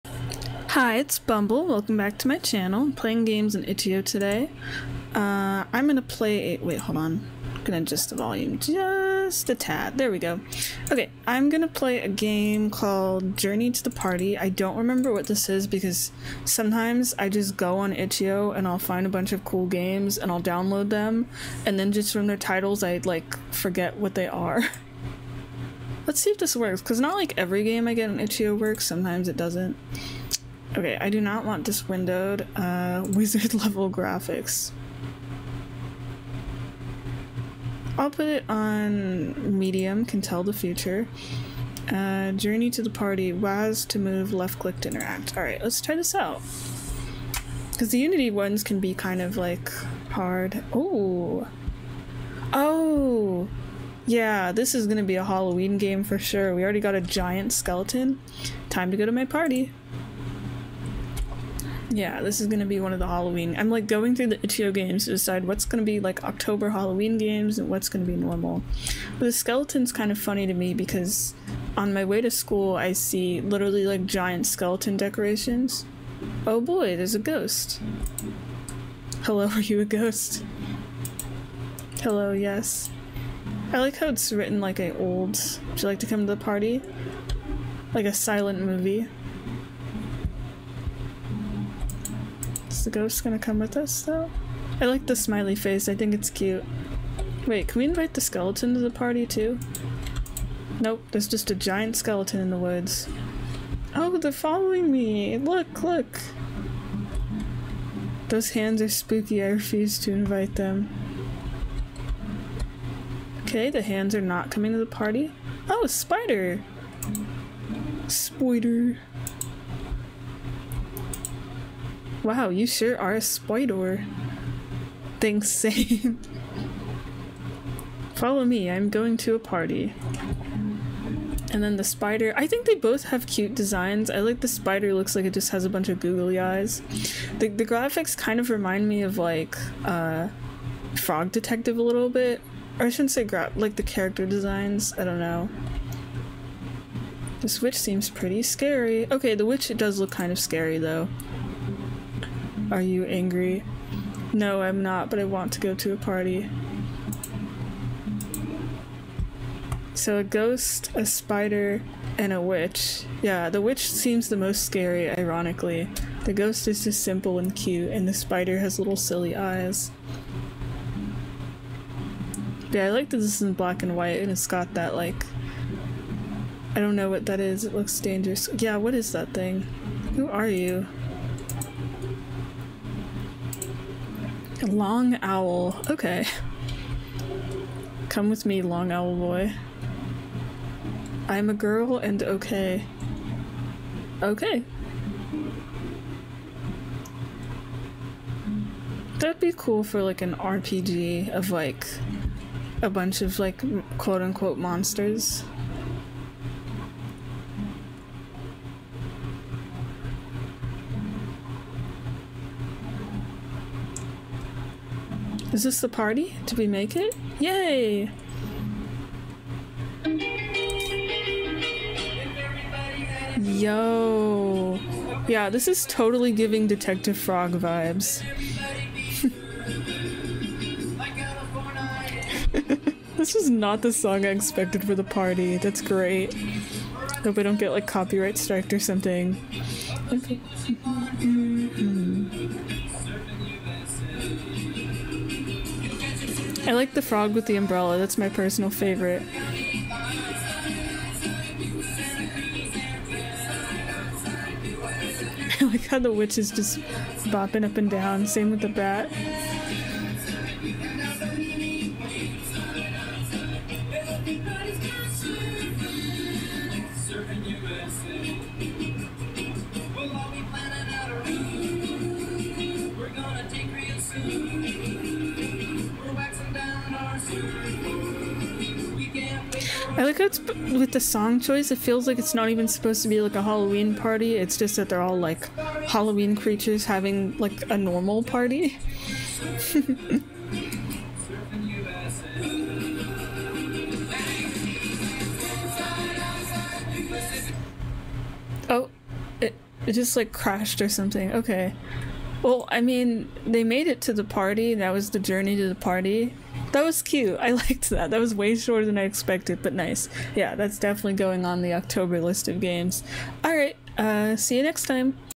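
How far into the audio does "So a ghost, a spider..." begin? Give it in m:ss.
2:39.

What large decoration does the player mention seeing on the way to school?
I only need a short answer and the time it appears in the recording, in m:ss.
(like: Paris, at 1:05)
giant skeleton decorations, at 1:14.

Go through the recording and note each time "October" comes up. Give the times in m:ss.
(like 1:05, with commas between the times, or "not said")
1:06, 5:11.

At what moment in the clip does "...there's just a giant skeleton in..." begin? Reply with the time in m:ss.
1:41.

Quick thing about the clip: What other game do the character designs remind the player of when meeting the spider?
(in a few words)
Frog Detective.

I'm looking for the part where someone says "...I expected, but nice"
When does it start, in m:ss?
5:08.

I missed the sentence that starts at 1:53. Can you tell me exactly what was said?
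Okay, the hands are not coming to the party.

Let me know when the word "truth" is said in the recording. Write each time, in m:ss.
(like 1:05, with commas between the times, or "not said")
not said.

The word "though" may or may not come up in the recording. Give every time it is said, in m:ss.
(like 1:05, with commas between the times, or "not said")
1:34, 2:30.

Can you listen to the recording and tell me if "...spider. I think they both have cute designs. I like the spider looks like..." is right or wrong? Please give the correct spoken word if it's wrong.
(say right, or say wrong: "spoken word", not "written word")
right.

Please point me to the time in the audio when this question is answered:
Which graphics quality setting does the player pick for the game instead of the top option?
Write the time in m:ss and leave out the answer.
0:39.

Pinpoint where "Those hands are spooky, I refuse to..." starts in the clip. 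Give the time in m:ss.
1:48.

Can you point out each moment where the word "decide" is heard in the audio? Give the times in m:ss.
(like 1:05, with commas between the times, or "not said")
1:05.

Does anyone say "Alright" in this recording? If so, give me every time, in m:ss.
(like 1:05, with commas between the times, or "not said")
0:45.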